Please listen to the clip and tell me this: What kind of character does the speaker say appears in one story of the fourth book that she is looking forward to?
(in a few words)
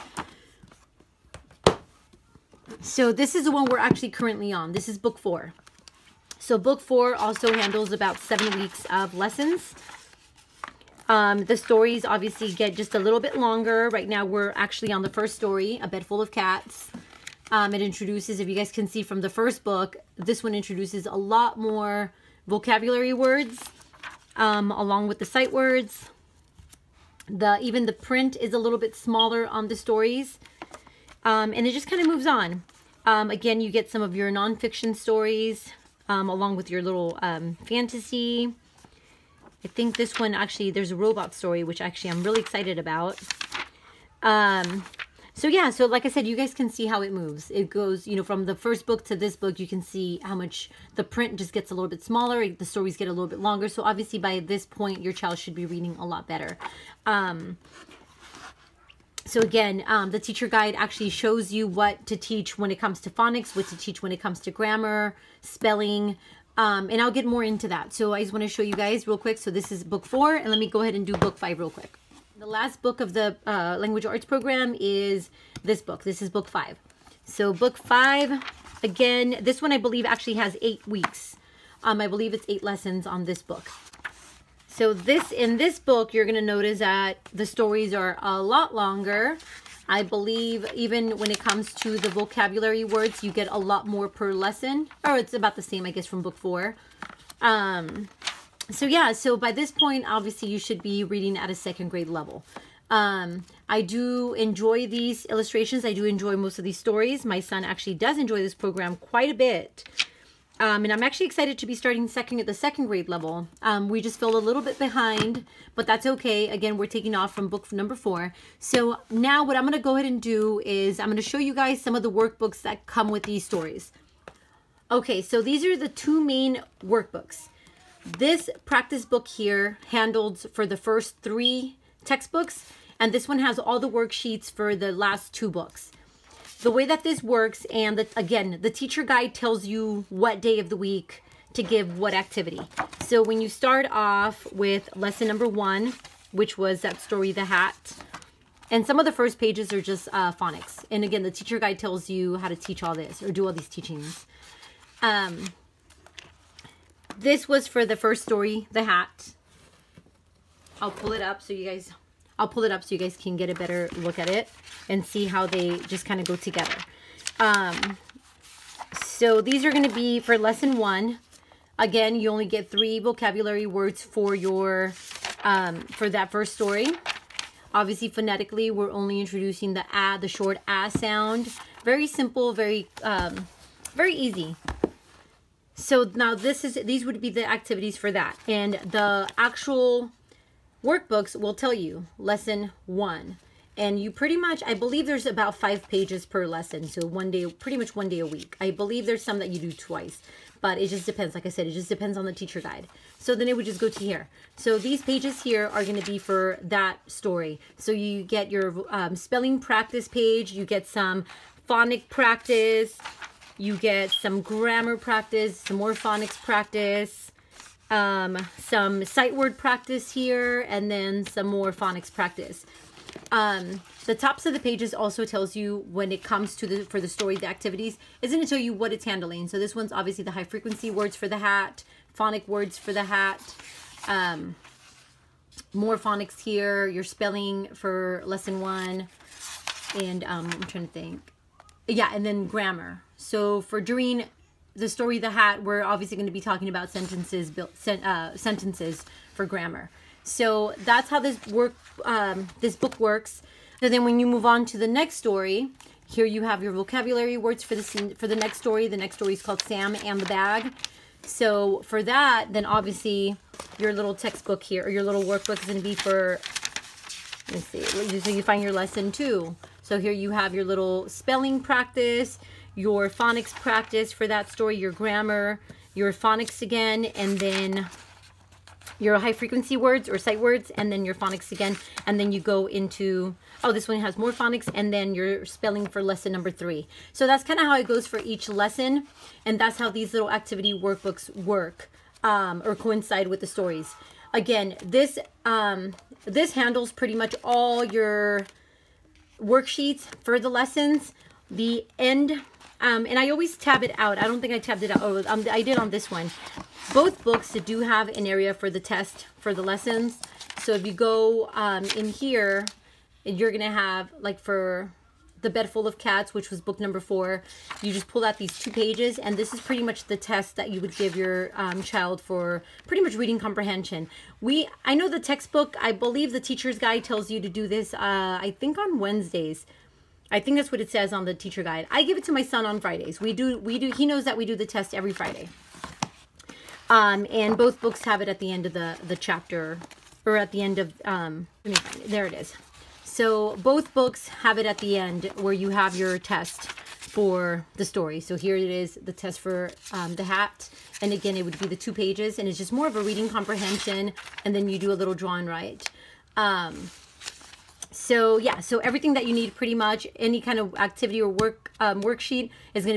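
Robot.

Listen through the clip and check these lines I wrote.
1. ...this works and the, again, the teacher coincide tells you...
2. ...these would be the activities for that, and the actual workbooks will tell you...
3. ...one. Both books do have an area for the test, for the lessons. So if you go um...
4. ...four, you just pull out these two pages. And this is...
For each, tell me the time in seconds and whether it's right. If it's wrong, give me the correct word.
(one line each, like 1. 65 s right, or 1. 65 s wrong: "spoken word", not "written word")
1. 137 s wrong: "guide", not "coincide"
2. 186 s right
3. 306 s right
4. 317 s right.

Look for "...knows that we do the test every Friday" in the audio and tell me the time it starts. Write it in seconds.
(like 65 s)
334 s.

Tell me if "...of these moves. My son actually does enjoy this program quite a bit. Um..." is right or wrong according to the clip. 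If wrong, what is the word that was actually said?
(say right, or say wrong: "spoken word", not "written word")
wrong: "stories", not "moves".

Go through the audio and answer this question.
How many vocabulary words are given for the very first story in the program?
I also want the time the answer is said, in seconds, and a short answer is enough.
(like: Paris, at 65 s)
3, at 172 s.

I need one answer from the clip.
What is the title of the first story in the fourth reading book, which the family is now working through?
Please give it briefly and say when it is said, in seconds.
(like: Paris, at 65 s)
A Bed Full of Cats, at 15 s.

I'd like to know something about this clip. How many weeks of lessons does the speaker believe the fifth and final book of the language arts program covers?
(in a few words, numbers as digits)
8.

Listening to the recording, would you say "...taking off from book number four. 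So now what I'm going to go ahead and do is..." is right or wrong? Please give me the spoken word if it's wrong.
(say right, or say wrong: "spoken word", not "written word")
right.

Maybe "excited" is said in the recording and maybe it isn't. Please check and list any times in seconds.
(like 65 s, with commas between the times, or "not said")
42 s, 111 s.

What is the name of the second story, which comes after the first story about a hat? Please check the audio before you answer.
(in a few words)
Sam and the Bag.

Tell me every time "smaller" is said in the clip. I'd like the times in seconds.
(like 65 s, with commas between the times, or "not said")
28 s, 52 s.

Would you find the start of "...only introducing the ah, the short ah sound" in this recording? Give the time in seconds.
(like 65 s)
178 s.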